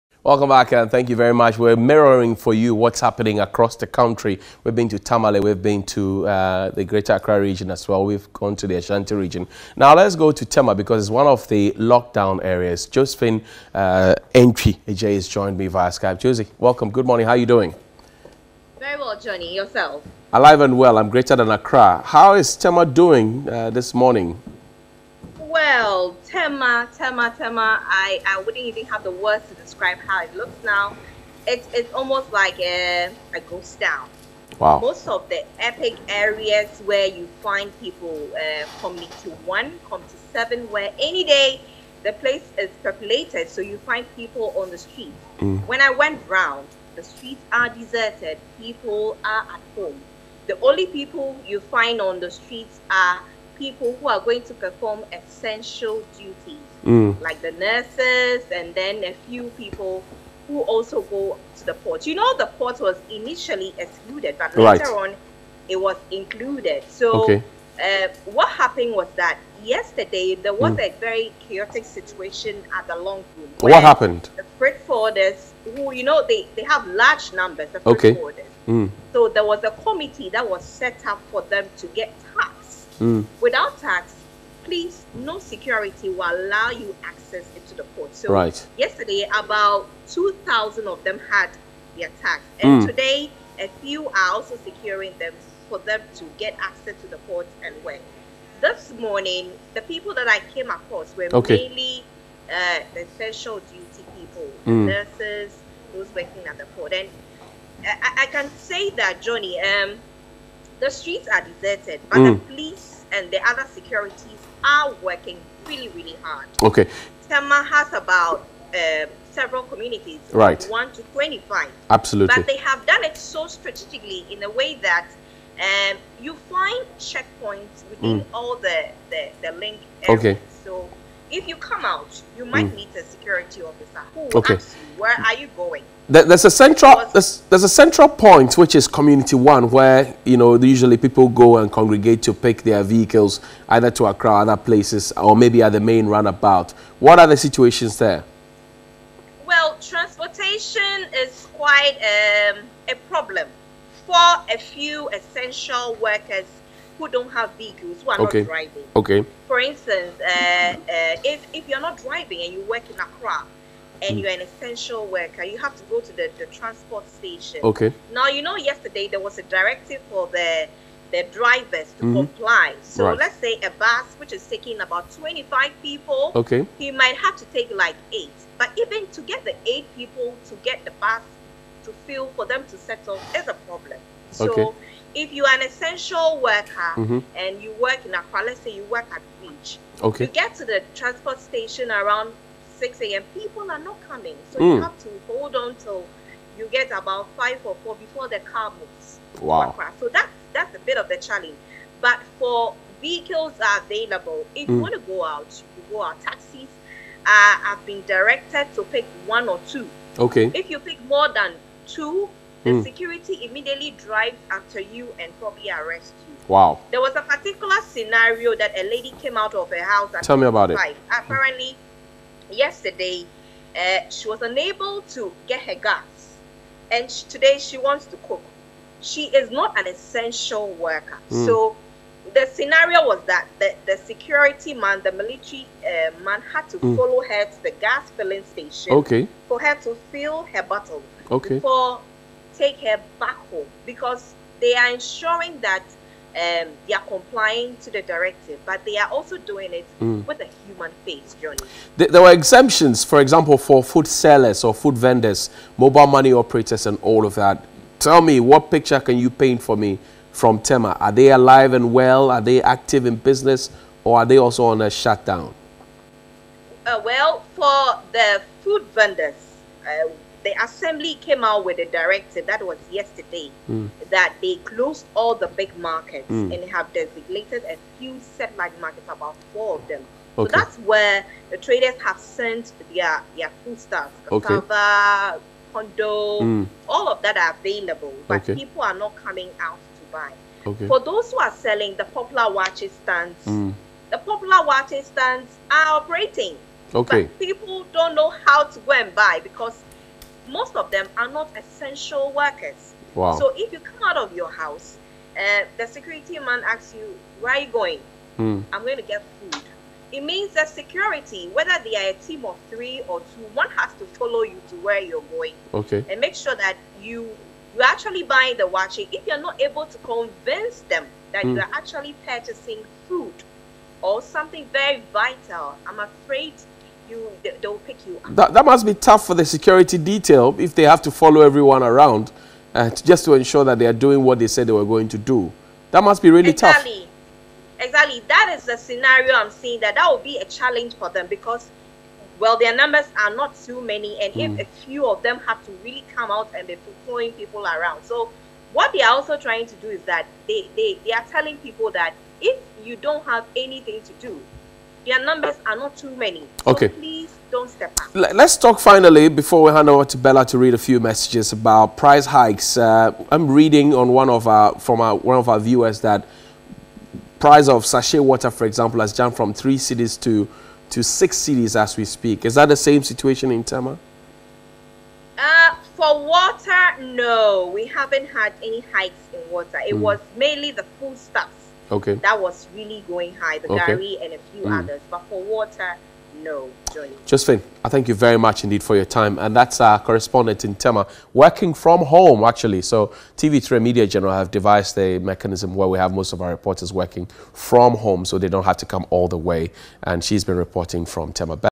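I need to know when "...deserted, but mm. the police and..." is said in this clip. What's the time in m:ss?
1:51.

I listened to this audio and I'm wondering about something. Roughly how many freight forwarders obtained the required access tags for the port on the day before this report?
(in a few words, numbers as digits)
2,000.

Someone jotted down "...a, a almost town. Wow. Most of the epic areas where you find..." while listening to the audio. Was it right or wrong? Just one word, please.
wrong.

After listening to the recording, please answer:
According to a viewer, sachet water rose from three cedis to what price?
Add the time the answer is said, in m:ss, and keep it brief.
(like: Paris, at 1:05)
6 cedis, at 6:11.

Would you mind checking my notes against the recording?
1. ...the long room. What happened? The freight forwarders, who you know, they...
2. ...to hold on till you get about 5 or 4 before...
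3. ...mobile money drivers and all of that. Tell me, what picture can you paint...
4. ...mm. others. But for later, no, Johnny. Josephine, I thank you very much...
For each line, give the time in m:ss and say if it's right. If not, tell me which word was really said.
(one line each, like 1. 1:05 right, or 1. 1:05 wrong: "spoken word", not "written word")
1. 1:12 right
2. 3:15 right
3. 4:15 wrong: "operators", not "drivers"
4. 6:24 wrong: "water", not "later".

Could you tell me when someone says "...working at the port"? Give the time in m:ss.
1:46.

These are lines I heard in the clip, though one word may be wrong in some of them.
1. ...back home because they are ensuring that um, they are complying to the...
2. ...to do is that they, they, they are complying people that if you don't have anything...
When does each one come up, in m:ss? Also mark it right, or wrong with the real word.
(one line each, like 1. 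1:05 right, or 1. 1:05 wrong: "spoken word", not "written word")
1. 4:03 right
2. 5:49 wrong: "telling", not "complying".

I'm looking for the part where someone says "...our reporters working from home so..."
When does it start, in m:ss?
6:36.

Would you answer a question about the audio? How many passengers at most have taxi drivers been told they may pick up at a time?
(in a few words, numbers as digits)
1 or 2.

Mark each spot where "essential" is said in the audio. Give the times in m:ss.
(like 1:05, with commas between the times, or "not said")
0:55, 1:43, 2:35, 2:44, 3:05, 3:49, 5:01.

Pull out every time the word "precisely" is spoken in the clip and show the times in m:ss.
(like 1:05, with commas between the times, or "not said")
not said.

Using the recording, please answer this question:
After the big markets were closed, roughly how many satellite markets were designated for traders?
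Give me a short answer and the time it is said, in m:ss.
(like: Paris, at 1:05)
4, at 4:39.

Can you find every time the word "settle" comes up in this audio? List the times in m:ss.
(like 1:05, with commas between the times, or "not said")
3:02.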